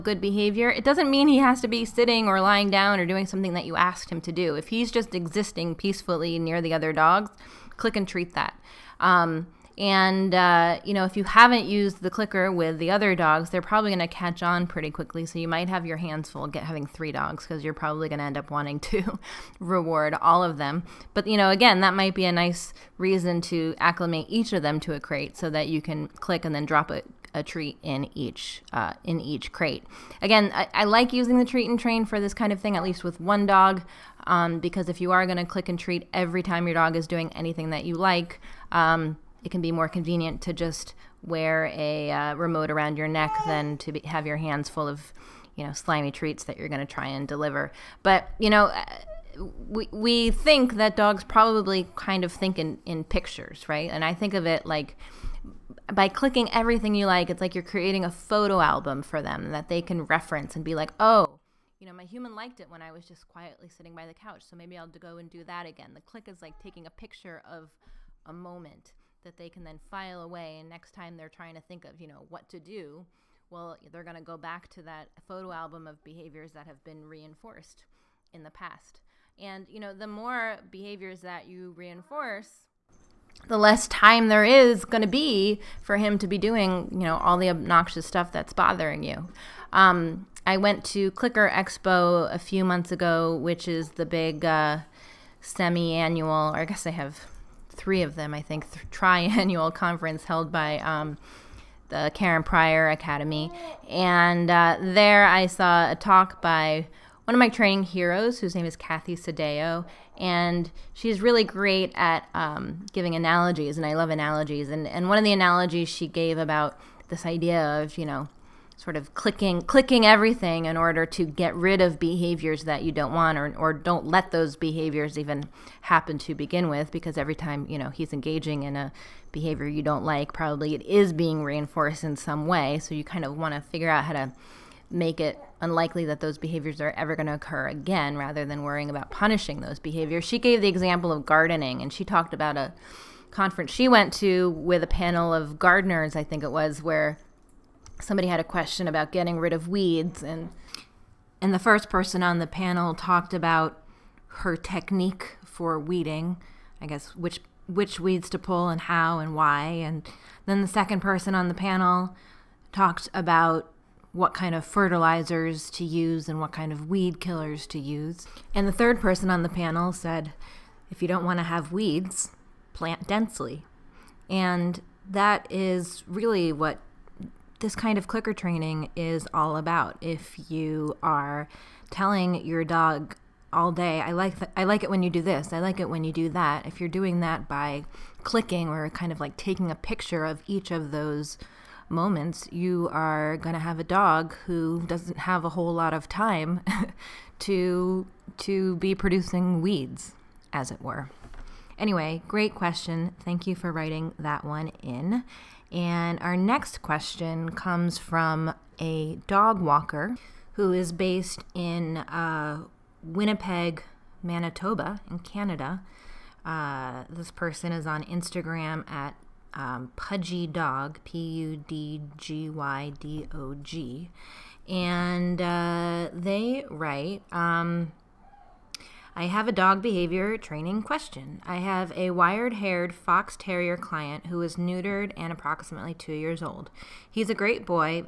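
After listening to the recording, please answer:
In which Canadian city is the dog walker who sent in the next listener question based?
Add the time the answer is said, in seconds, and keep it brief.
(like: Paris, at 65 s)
Winnipeg, at 213 s.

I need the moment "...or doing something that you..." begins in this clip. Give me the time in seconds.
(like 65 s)
2 s.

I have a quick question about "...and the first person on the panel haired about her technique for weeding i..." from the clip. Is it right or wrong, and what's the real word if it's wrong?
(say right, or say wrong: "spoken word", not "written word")
wrong: "talked", not "haired".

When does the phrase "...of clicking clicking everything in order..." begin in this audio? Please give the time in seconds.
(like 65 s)
118 s.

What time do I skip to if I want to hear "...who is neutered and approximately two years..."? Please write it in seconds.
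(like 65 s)
234 s.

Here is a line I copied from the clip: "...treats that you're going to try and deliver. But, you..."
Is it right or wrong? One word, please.
right.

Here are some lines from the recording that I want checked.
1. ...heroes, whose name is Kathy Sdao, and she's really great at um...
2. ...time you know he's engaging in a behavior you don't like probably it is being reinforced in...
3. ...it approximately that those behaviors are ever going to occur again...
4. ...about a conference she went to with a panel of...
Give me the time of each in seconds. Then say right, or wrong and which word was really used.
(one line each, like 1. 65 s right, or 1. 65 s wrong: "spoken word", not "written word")
1. 107 s right
2. 127 s right
3. 135 s wrong: "unlikely", not "approximately"
4. 142 s right.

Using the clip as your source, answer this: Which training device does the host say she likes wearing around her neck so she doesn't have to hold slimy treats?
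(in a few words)
Treat and Train.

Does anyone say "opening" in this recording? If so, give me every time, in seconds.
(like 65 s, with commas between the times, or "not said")
not said.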